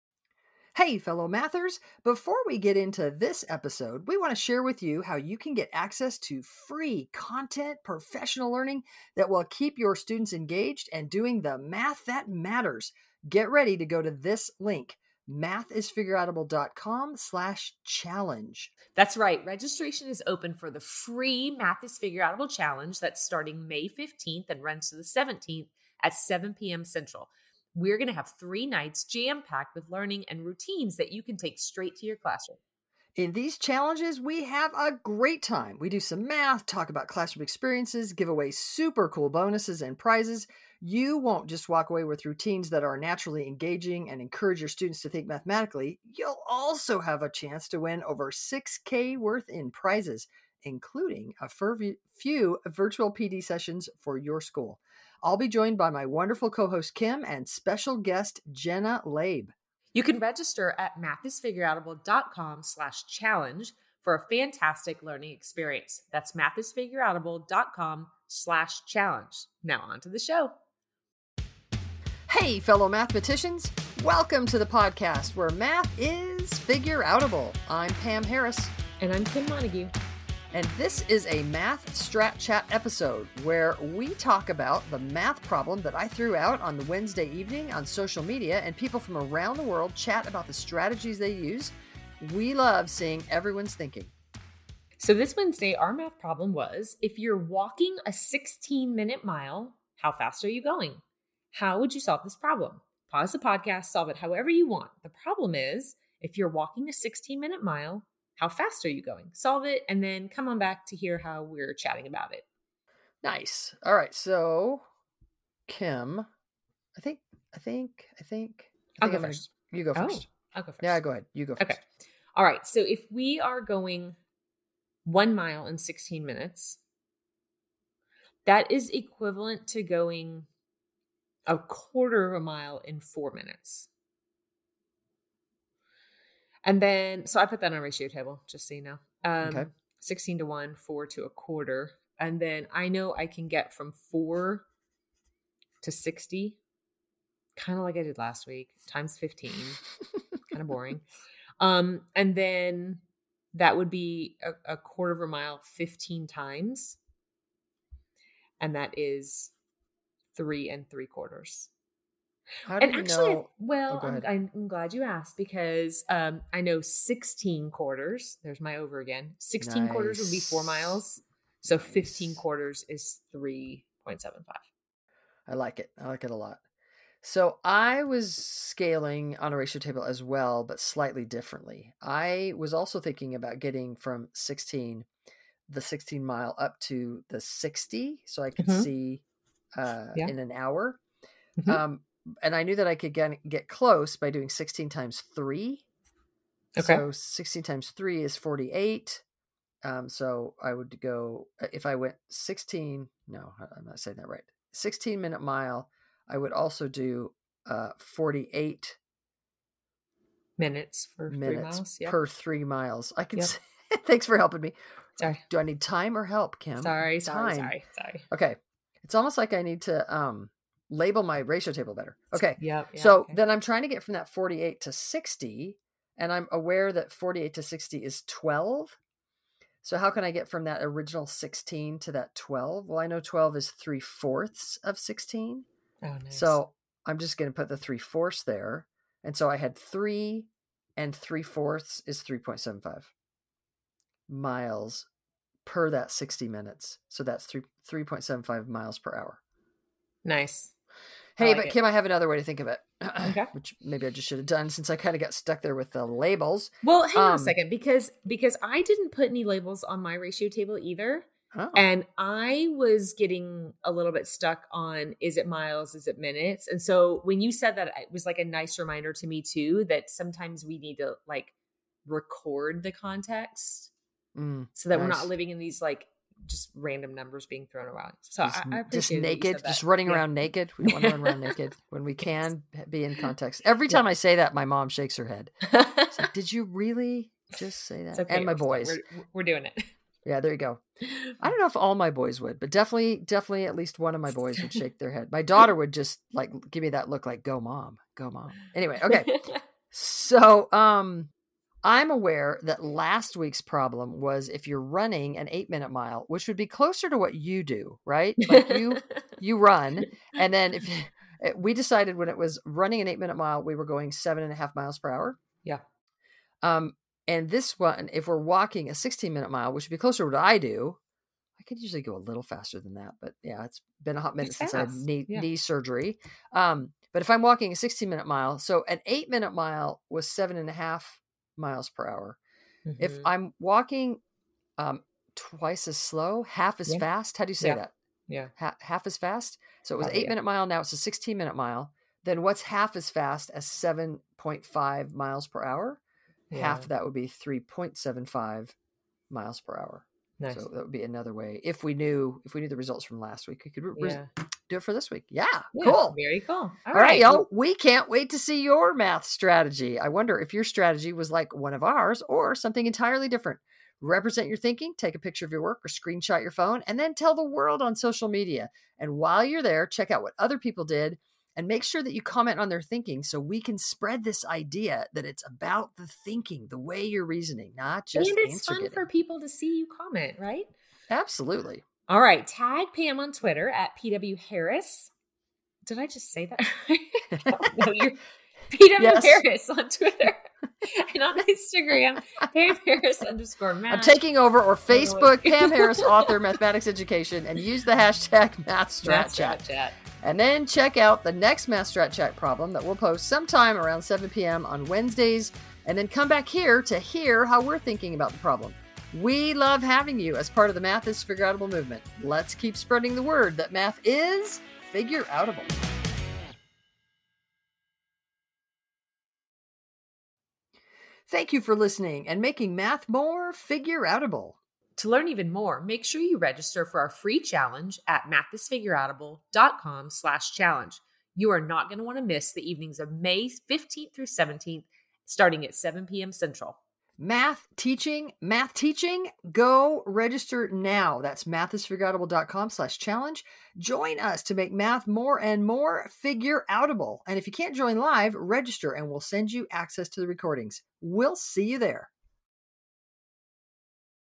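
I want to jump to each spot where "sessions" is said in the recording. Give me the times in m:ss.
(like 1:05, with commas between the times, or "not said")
0:53.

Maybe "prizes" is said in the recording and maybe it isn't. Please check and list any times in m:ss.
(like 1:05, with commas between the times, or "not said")
0:39, 0:49.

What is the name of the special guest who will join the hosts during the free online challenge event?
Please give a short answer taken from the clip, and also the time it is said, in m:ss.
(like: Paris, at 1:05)
Jenna Laib, at 0:58.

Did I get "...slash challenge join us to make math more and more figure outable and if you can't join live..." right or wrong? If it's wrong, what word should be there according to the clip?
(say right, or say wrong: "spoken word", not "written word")
right.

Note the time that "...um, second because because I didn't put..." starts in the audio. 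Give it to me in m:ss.
4:17.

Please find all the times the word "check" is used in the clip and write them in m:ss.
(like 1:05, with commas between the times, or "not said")
6:09, 6:40.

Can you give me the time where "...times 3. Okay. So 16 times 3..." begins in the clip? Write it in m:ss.
3:14.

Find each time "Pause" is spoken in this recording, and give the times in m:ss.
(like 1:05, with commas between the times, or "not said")
1:43.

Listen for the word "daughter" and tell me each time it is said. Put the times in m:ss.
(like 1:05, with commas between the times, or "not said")
4:55.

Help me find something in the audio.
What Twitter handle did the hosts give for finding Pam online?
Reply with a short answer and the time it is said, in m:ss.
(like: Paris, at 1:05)
PW Harris, at 6:24.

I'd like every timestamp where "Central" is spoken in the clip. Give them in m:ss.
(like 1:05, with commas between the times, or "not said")
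0:26, 7:16.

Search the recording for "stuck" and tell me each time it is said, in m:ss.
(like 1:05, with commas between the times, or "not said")
4:15, 4:24.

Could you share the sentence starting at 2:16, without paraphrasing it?
And then, so I put that on a ratio table, just so you know.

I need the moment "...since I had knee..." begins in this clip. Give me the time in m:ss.
5:24.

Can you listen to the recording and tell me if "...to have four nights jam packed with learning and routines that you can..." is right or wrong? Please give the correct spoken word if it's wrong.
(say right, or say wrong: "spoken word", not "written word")
wrong: "three", not "four".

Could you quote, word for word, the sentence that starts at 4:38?
So just, I, I just naked, just running yeah.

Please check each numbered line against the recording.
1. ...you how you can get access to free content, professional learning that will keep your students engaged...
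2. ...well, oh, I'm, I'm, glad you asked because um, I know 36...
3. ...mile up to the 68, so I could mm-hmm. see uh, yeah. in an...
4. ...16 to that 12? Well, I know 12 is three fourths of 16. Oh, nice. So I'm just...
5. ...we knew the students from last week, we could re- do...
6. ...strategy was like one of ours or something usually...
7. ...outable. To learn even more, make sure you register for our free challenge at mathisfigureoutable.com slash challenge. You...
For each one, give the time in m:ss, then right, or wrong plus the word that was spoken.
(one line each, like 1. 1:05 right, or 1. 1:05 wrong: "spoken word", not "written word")
1. 0:04 right
2. 2:43 wrong: "16", not "36"
3. 3:06 wrong: "60", not "68"
4. 3:51 right
5. 5:52 wrong: "results", not "students"
6. 6:00 wrong: "entirely", not "usually"
7. 7:04 right.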